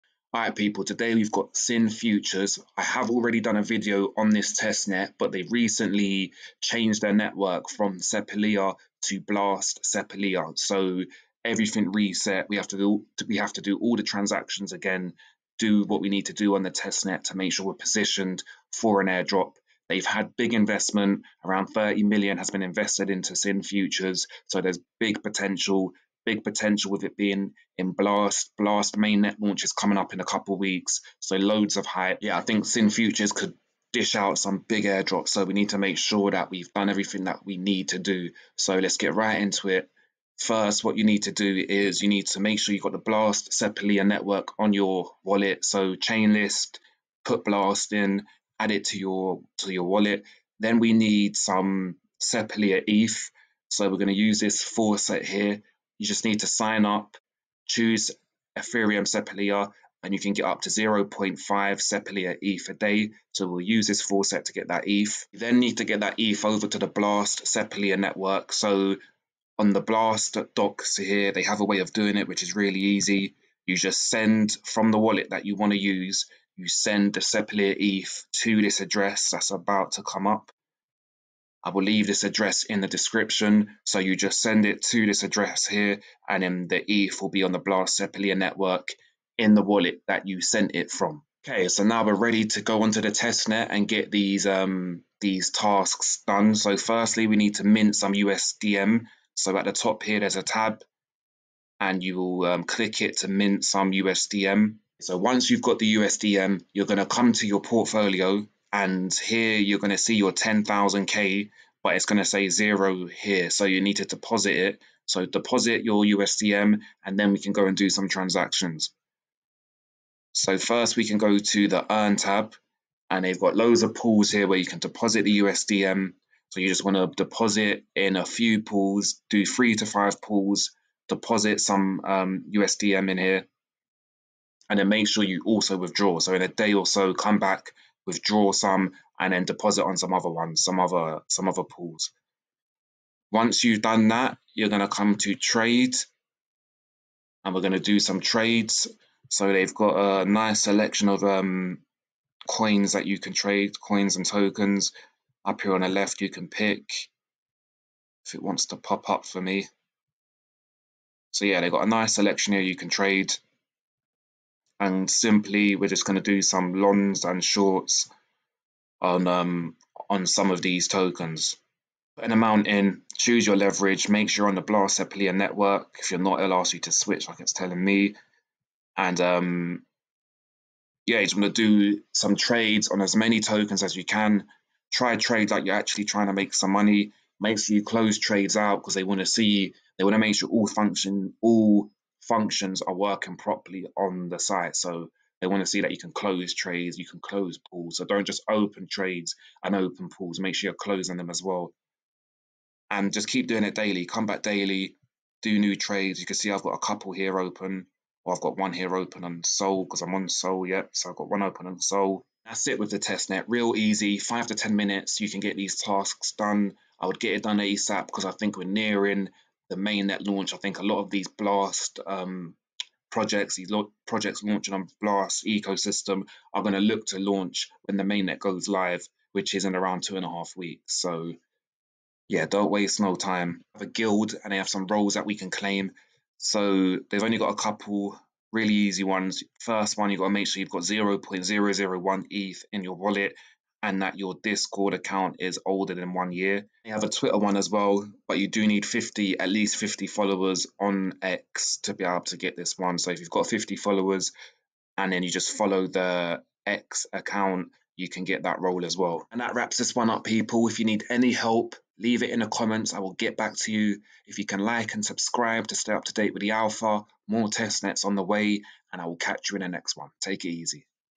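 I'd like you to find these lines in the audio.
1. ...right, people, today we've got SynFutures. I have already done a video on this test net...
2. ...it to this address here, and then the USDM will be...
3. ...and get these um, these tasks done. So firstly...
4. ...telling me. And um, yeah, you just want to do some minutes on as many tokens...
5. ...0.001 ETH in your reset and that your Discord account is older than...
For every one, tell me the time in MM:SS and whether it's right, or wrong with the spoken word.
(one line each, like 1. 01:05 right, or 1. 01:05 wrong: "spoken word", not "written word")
1. 00:00 right
2. 01:24 wrong: "ETH", not "USDM"
3. 01:33 right
4. 02:57 wrong: "trades", not "minutes"
5. 04:00 wrong: "wallet", not "reset".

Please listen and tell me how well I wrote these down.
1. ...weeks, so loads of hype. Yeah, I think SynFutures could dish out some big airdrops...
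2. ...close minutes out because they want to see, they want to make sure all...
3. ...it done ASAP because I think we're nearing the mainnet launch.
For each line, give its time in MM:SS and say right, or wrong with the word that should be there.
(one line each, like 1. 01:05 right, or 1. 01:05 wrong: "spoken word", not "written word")
1. 00:30 right
2. 03:07 wrong: "trades", not "minutes"
3. 03:37 right.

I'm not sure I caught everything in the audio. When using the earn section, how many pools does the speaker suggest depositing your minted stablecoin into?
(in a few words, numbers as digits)
3 to 5.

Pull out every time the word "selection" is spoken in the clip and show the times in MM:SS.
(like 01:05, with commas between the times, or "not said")
02:30, 02:42.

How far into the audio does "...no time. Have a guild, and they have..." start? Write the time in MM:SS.
03:52.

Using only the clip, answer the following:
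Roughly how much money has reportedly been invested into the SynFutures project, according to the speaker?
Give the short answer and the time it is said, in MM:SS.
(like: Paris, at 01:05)
30 million, at 00:21.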